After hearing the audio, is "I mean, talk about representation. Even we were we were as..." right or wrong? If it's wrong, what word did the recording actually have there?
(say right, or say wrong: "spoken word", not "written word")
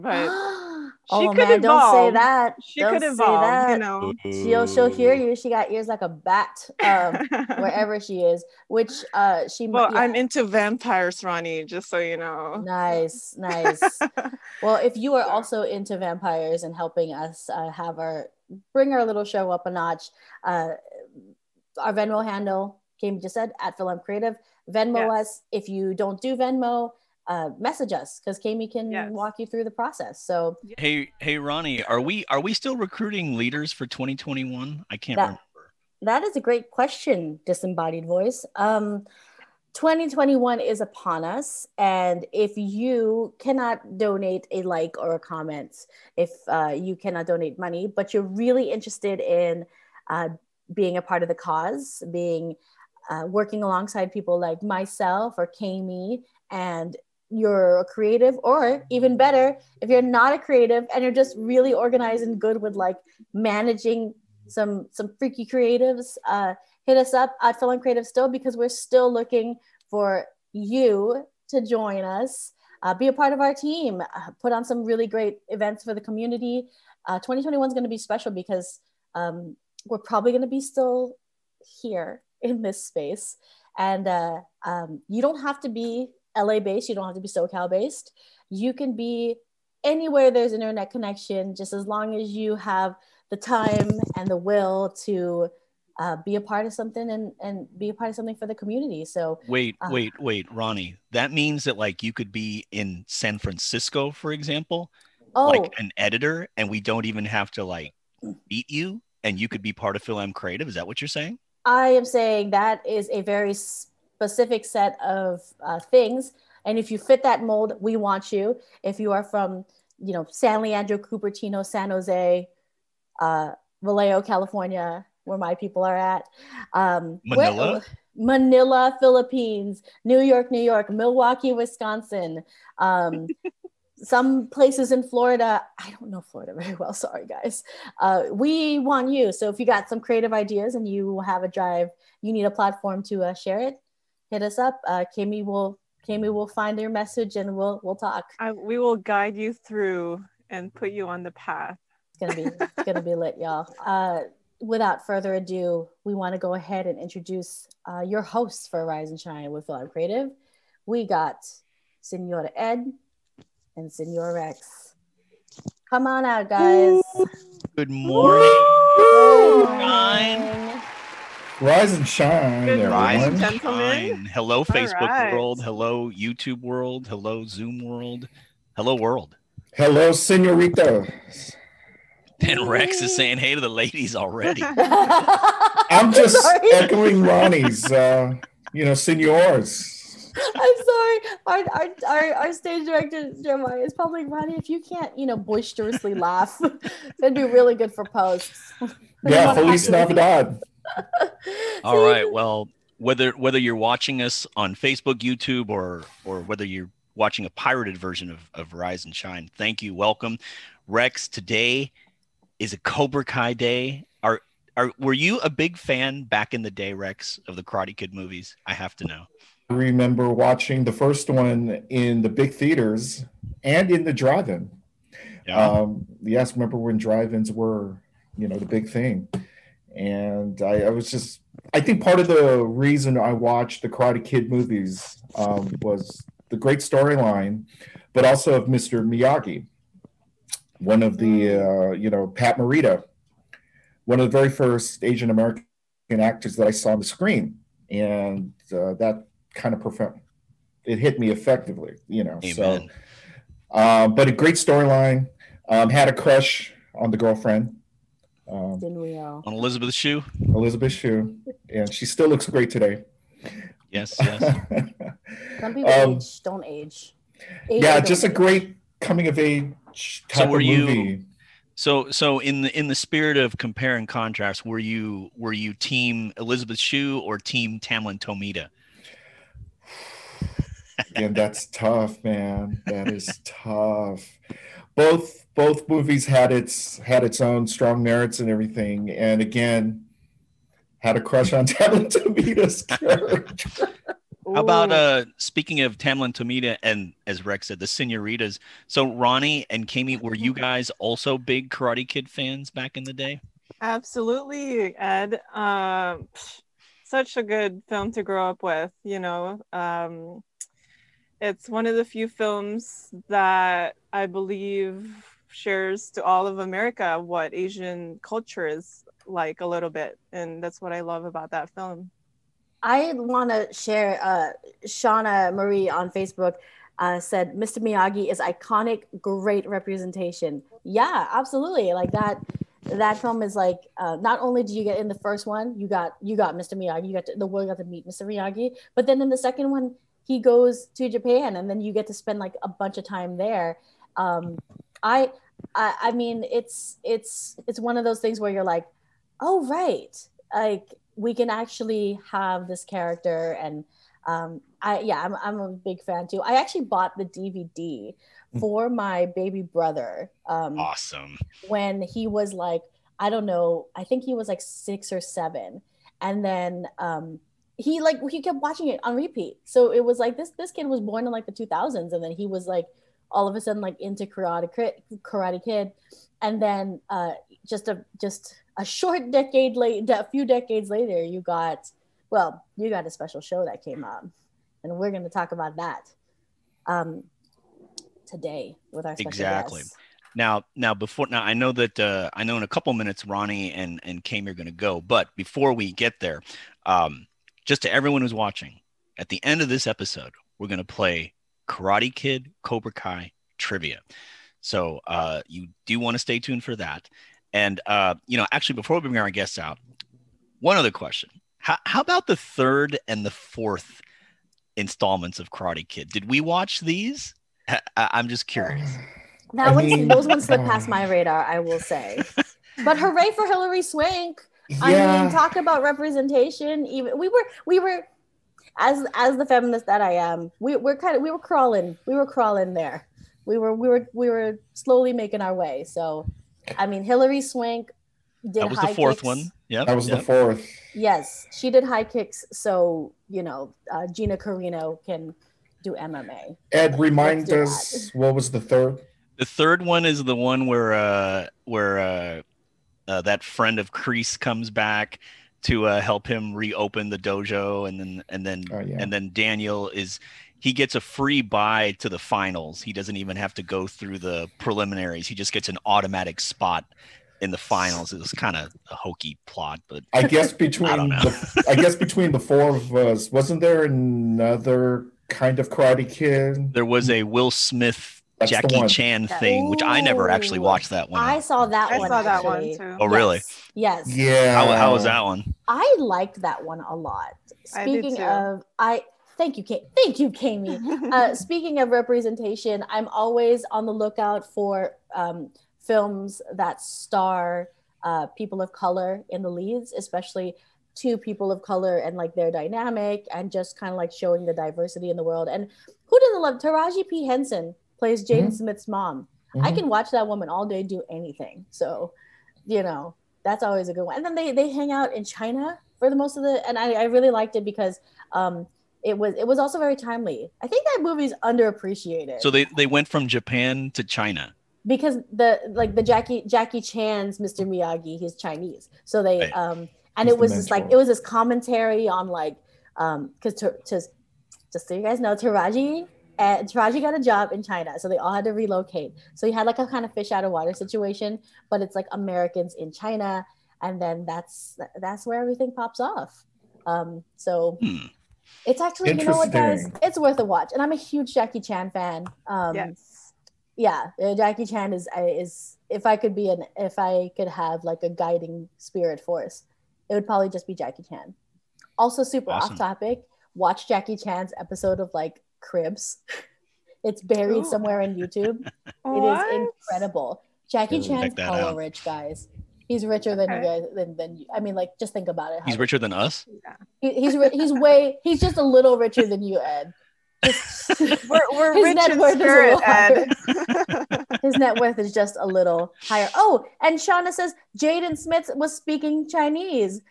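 right.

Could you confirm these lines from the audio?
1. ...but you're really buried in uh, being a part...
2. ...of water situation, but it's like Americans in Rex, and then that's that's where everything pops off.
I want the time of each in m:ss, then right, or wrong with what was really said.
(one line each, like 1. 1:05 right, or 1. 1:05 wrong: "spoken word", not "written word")
1. 0:47 wrong: "interested", not "buried"
2. 9:00 wrong: "China", not "Rex".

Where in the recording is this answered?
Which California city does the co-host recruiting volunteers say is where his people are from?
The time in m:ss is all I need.
2:03.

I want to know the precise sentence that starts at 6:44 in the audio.
So uh, you do want to stay tuned for that.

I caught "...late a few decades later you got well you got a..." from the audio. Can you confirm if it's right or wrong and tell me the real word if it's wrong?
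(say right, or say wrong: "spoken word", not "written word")
right.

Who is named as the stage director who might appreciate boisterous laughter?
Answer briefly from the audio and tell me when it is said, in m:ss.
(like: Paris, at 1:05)
Jeremiah, at 3:13.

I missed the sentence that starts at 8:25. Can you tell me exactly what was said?
And who doesn't love Taraji P.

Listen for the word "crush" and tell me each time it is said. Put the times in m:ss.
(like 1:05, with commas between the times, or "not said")
4:16, 4:51.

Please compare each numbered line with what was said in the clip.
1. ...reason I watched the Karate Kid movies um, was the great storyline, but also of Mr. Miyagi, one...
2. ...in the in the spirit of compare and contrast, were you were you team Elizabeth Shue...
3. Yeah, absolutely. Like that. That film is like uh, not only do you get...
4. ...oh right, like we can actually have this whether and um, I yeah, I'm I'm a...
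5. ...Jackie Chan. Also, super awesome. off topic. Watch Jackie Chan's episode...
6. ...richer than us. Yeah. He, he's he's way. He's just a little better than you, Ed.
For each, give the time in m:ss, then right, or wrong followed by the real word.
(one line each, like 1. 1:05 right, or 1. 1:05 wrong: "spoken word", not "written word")
1. 3:52 right
2. 4:32 right
3. 5:30 right
4. 5:49 wrong: "character", not "whether"
5. 9:20 right
6. 9:35 wrong: "richer", not "better".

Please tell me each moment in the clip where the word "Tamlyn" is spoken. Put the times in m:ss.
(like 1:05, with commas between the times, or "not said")
4:37, 4:51, 4:55.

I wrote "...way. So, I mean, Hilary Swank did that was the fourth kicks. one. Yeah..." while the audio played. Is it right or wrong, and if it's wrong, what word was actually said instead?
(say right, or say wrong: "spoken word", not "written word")
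right.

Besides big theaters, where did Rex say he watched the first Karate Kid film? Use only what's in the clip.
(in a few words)
The drive-in.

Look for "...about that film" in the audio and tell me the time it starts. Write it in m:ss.
5:21.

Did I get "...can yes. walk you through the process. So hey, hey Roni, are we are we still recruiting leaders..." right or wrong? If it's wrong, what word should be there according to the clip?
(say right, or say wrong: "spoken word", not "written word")
right.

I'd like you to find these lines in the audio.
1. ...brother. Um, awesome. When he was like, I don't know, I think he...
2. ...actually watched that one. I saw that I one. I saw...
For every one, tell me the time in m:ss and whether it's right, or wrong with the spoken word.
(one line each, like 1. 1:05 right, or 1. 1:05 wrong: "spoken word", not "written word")
1. 5:59 right
2. 8:00 right.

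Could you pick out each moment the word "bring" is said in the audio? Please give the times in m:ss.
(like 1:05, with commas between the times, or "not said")
0:18, 6:49.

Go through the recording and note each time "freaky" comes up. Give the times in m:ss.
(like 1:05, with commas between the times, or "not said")
1:05.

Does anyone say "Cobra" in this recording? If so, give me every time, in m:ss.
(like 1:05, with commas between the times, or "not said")
3:32, 6:42.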